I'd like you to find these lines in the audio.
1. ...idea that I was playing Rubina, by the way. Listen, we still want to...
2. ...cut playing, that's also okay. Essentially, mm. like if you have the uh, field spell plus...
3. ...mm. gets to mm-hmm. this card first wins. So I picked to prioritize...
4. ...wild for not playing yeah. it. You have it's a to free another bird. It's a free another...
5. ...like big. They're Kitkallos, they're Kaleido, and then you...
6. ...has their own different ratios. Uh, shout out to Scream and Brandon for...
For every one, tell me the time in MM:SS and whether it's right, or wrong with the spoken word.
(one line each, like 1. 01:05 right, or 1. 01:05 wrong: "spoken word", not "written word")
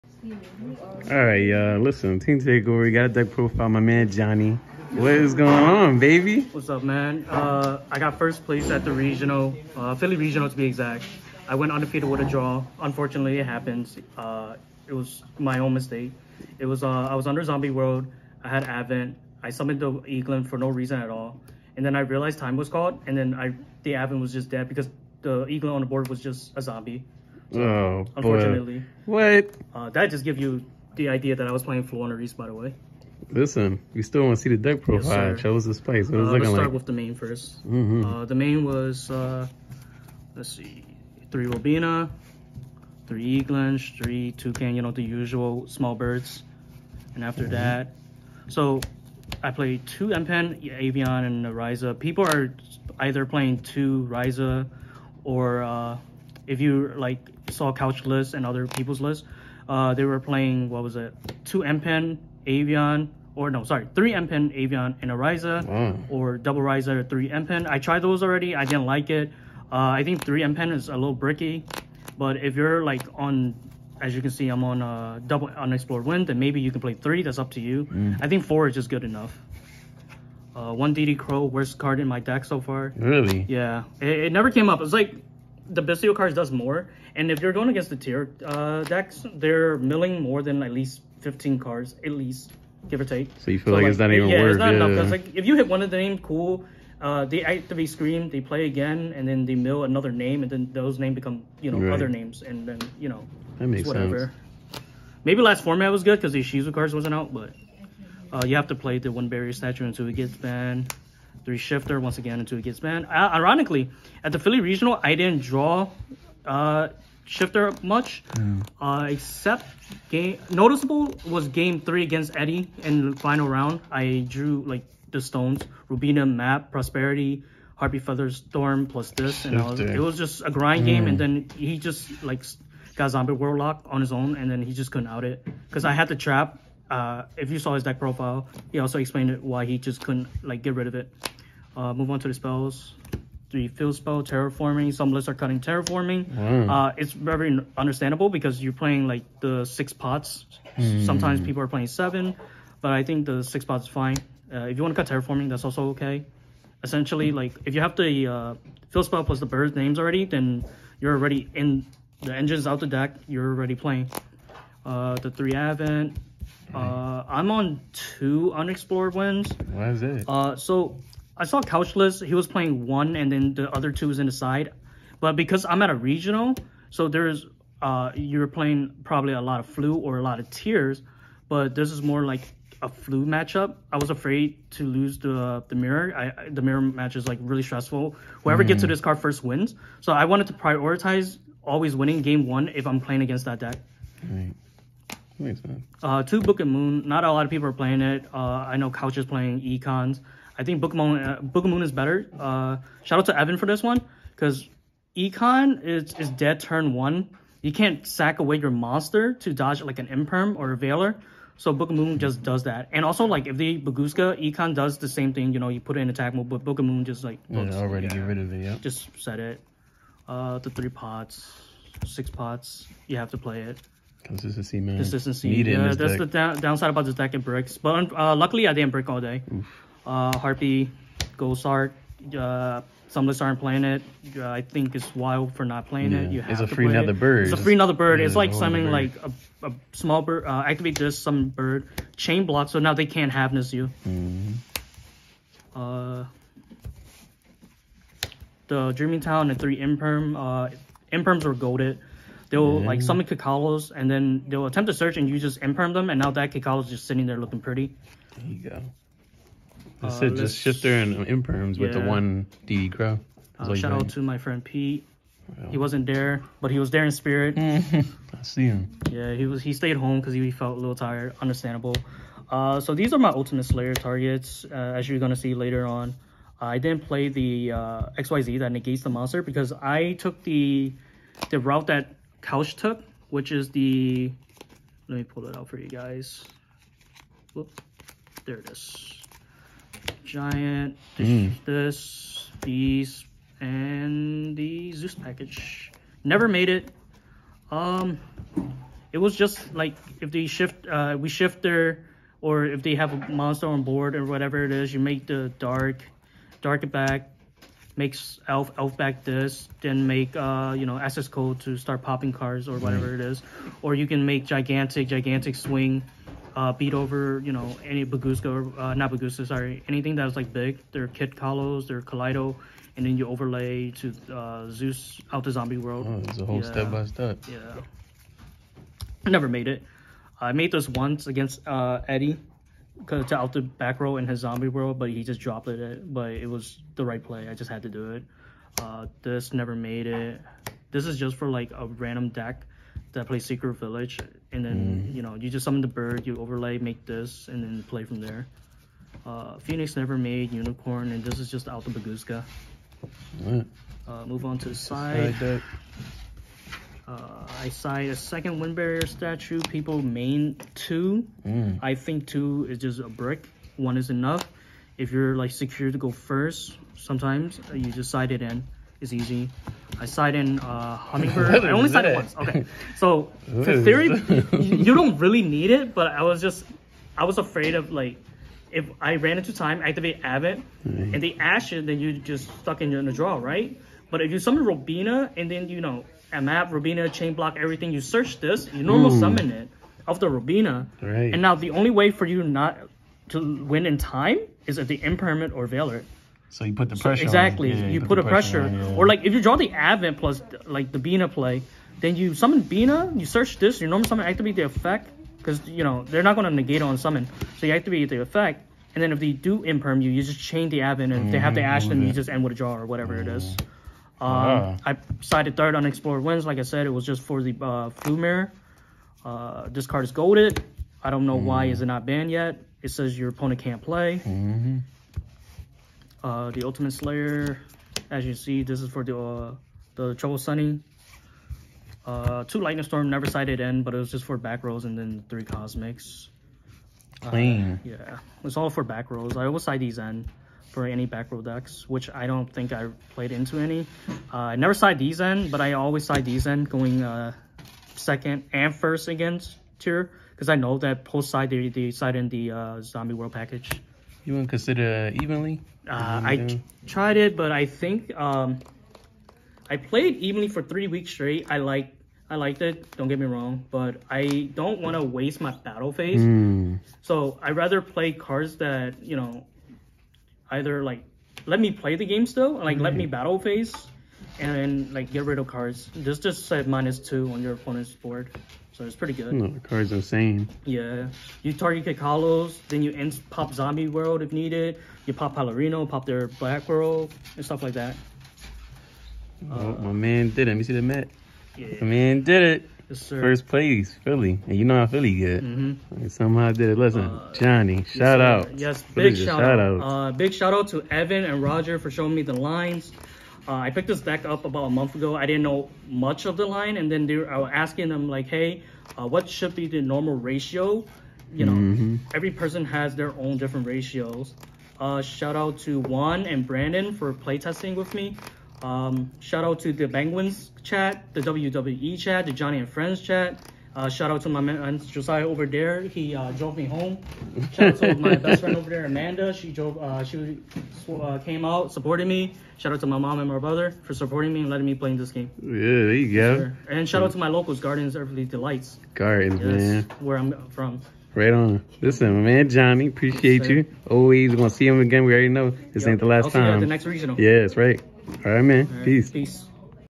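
1. 00:31 wrong: "Floowandereeze", not "Rubina"
2. 02:35 wrong: "terraforming", not "playing"
3. 03:08 wrong: "wanted", not "picked"
4. 03:55 right
5. 05:20 right
6. 08:32 wrong: "Juan", not "Scream".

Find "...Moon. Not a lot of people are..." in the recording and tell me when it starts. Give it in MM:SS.
03:16.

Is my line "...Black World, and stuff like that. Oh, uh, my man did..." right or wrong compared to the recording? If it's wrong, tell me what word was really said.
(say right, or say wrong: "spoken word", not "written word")
right.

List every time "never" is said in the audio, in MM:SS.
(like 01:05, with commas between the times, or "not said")
01:24, 04:56, 05:29, 05:39, 05:49, 07:13, 07:24.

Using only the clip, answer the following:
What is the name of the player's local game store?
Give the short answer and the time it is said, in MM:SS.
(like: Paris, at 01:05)
Gardens Earthly Delights, at 08:57.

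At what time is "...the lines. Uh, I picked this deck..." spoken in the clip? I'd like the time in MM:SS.
08:22.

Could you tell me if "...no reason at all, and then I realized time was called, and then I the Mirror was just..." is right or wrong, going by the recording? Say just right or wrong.
wrong.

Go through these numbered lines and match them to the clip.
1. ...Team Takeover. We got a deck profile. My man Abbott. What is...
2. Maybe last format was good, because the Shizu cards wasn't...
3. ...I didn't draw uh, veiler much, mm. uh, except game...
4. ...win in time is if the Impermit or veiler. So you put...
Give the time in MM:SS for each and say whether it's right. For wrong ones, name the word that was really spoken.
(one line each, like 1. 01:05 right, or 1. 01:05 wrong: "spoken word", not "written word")
1. 00:02 wrong: "Johnny", not "Abbott"
2. 01:45 right
3. 01:55 wrong: "shifter", not "veiler"
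4. 06:33 right.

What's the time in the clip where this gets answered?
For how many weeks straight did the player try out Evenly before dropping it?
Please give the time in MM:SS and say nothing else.
07:40.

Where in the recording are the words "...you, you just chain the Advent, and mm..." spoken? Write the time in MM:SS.
06:50.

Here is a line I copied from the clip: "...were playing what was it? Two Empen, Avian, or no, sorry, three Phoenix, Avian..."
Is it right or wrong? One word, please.
wrong.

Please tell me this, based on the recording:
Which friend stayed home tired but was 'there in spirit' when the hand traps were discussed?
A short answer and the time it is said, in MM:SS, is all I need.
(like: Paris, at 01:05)
Pete, at 04:24.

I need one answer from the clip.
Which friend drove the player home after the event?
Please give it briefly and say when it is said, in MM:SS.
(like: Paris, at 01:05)
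Josiah, at 08:44.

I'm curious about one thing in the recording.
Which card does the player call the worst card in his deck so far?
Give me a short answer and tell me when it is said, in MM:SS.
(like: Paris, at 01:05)
DD Crow, at 01:20.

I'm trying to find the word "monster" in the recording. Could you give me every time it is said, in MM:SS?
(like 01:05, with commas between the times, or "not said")
03:28, 04:39, 05:03.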